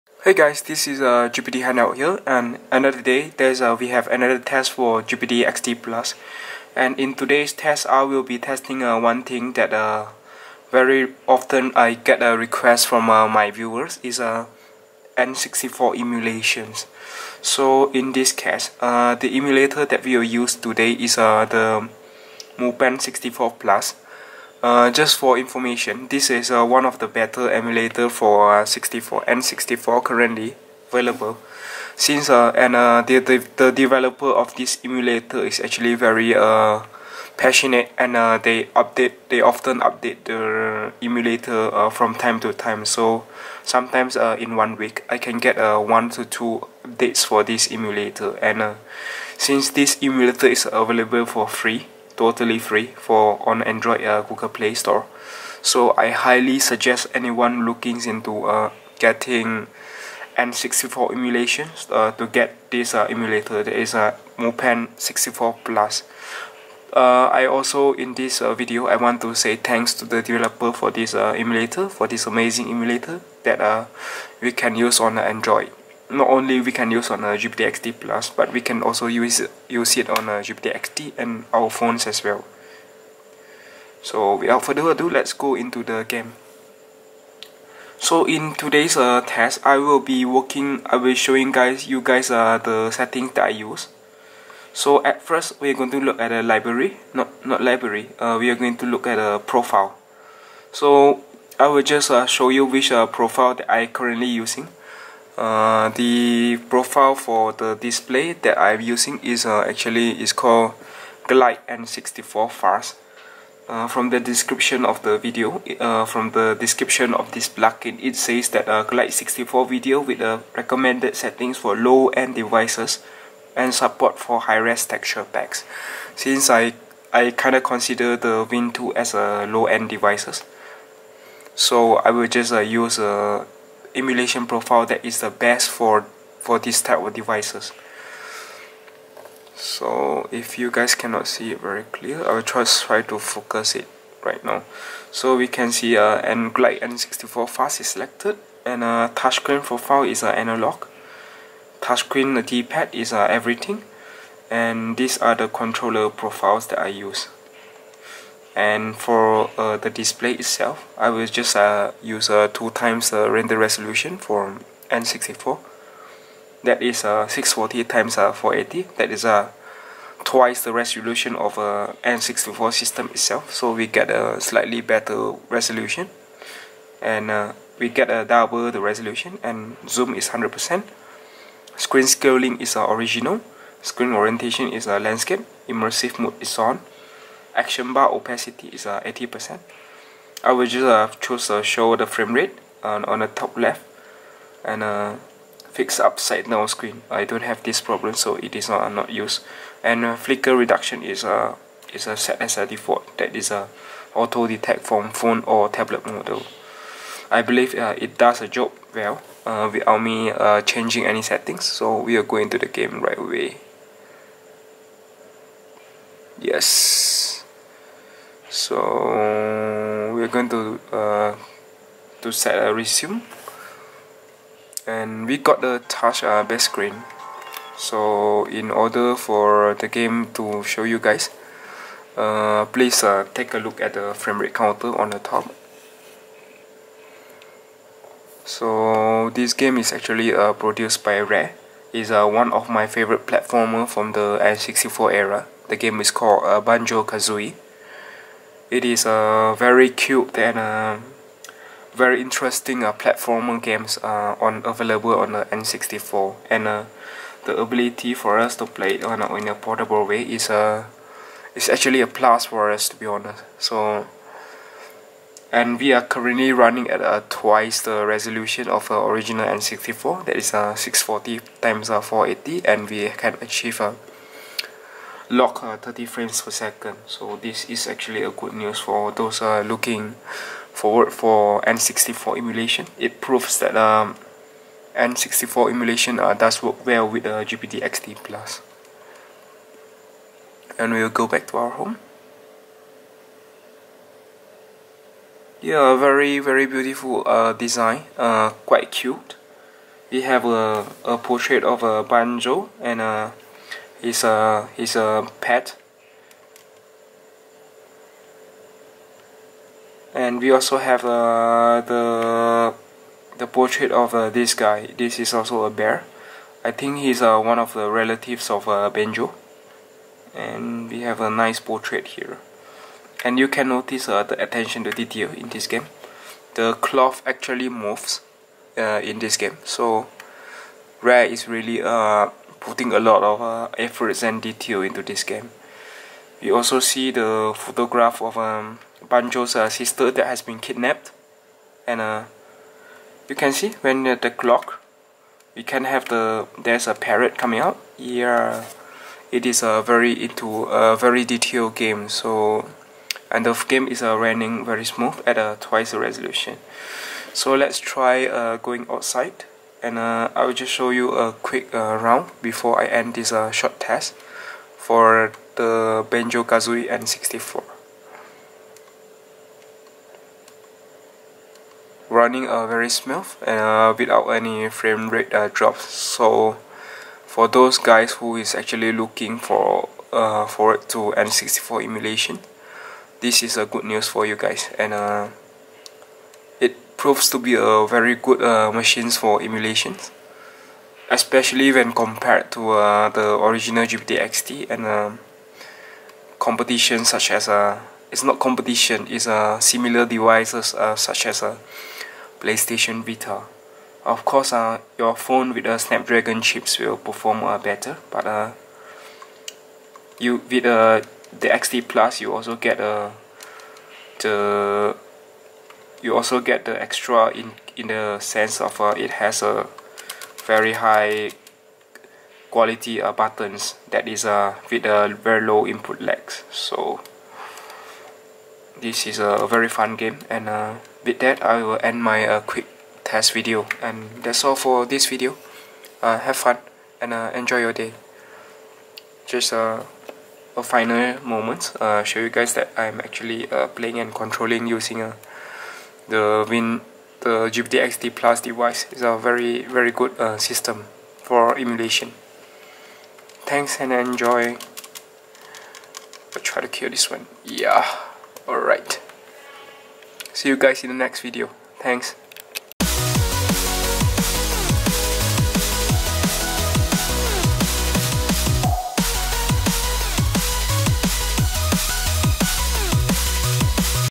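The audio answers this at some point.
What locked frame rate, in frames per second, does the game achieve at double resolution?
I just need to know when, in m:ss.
4:35.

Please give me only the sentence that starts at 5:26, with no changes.
The cloth actually moves uh, in this game.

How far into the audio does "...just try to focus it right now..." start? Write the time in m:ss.
2:22.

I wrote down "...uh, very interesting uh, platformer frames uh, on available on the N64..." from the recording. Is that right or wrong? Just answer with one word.
wrong.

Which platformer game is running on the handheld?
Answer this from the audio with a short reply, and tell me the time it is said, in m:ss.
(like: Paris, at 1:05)
Banjo-Kazooie, at 4:06.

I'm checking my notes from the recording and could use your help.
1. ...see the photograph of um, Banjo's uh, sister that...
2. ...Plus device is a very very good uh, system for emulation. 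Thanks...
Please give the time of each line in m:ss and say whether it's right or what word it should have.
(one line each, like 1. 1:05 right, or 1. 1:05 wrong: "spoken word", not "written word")
1. 5:36 right
2. 7:28 right.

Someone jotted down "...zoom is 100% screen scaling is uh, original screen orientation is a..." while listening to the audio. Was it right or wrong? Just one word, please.
right.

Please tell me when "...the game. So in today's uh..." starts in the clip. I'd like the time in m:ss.
1:25.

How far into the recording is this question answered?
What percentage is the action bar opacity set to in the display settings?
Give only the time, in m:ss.
3:08.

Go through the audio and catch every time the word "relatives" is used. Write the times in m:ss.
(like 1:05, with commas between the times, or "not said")
5:17.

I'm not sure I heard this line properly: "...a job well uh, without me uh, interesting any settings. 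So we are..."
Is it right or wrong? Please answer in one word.
wrong.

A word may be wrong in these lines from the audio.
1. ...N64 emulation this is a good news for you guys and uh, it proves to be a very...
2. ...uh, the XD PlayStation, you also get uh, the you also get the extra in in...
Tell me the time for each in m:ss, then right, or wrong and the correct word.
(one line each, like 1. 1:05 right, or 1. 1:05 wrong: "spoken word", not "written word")
1. 6:21 right
2. 6:50 wrong: "Plus", not "PlayStation".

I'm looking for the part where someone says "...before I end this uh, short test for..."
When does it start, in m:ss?
6:02.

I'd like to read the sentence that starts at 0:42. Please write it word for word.
So sometimes in one week I can get one to two updates for this emulator.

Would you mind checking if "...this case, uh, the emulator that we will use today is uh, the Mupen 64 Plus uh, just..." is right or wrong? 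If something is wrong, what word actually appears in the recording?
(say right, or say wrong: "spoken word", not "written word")
right.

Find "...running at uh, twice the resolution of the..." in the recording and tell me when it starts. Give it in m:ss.
4:26.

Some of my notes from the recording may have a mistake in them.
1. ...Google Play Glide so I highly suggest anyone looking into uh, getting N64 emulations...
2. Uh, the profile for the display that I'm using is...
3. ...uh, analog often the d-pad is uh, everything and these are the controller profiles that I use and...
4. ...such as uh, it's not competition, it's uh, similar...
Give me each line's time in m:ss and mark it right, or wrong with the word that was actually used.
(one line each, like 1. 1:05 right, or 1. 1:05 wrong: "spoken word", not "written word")
1. 0:54 wrong: "Store", not "Glide"
2. 1:45 right
3. 2:30 wrong: "touchscreen", not "often"
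4. 6:37 right.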